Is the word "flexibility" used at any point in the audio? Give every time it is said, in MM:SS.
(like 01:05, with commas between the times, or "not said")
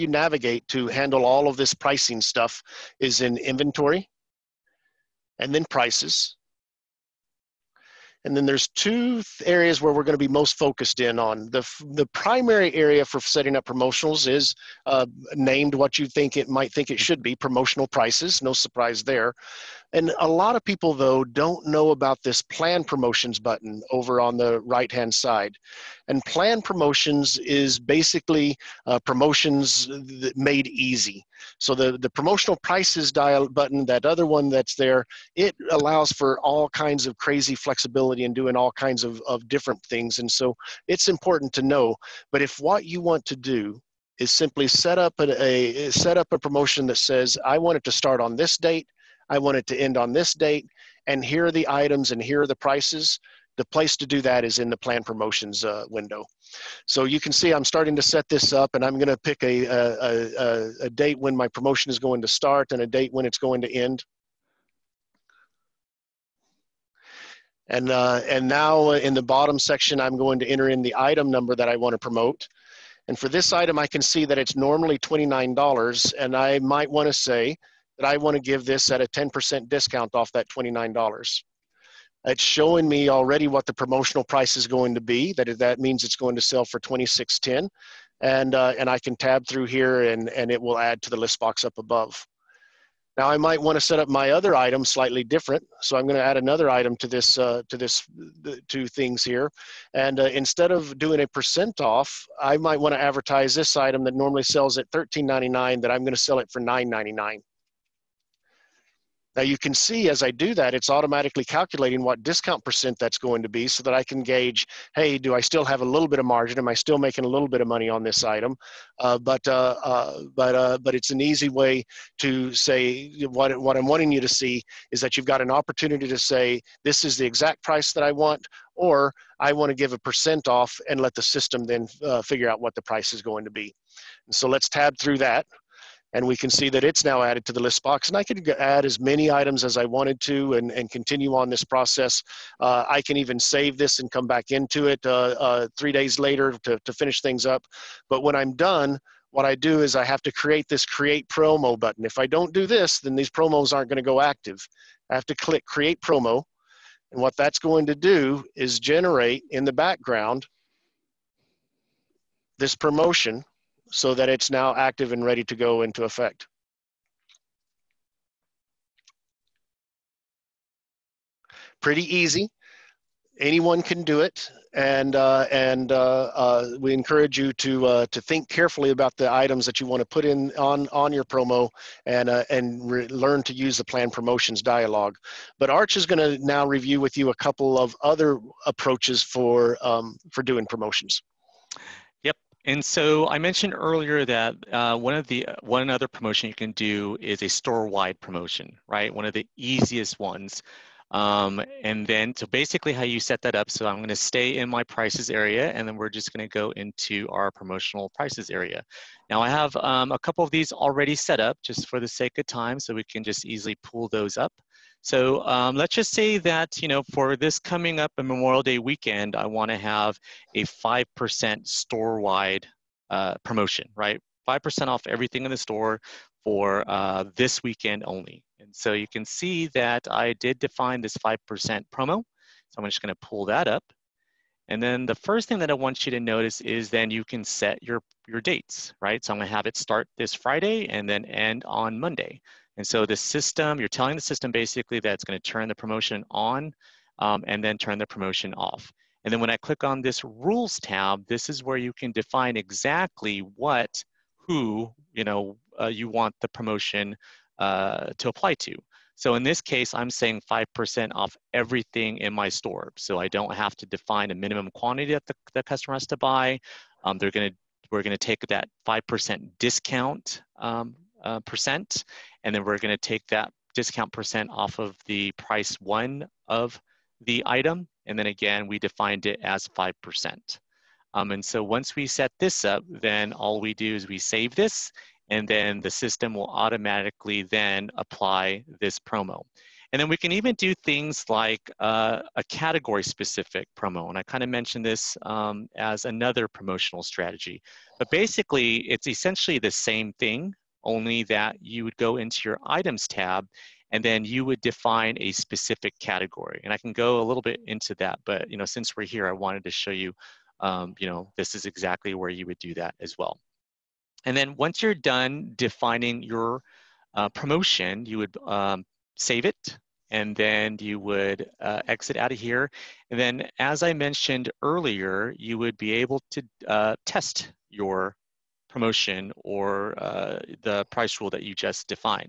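00:37.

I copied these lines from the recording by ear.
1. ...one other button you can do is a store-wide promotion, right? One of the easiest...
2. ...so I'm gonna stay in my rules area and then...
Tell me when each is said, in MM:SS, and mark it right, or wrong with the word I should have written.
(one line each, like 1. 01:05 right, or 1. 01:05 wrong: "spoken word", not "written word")
1. 03:15 wrong: "promotion", not "button"
2. 03:23 wrong: "prices", not "rules".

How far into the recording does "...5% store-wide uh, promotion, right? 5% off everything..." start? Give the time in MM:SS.
03:40.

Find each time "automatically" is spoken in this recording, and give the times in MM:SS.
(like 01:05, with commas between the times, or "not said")
01:50, 04:46.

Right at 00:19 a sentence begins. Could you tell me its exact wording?
And a lot of people, though, don't know about this plan promotions button over on the right hand side.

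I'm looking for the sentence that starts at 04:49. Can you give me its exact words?
And then we can even do things like uh, a category specific promo.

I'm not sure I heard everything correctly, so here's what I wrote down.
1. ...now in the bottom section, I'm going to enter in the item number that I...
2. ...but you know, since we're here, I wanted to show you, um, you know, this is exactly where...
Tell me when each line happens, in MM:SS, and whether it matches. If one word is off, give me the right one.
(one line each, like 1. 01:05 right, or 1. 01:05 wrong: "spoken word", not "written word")
1. 01:08 right
2. 05:08 right.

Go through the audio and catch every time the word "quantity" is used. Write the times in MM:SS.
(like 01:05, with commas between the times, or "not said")
04:24.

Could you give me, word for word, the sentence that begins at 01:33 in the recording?
Now I might want to set up my other item slightly different.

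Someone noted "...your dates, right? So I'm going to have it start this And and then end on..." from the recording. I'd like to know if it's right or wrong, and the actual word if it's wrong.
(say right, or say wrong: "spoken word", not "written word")
wrong: "Friday", not "And".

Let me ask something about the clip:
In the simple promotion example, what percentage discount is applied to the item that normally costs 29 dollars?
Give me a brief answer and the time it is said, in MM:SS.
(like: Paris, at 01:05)
10%, at 01:19.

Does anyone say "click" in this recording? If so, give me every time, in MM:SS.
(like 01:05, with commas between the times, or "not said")
02:35, 04:09.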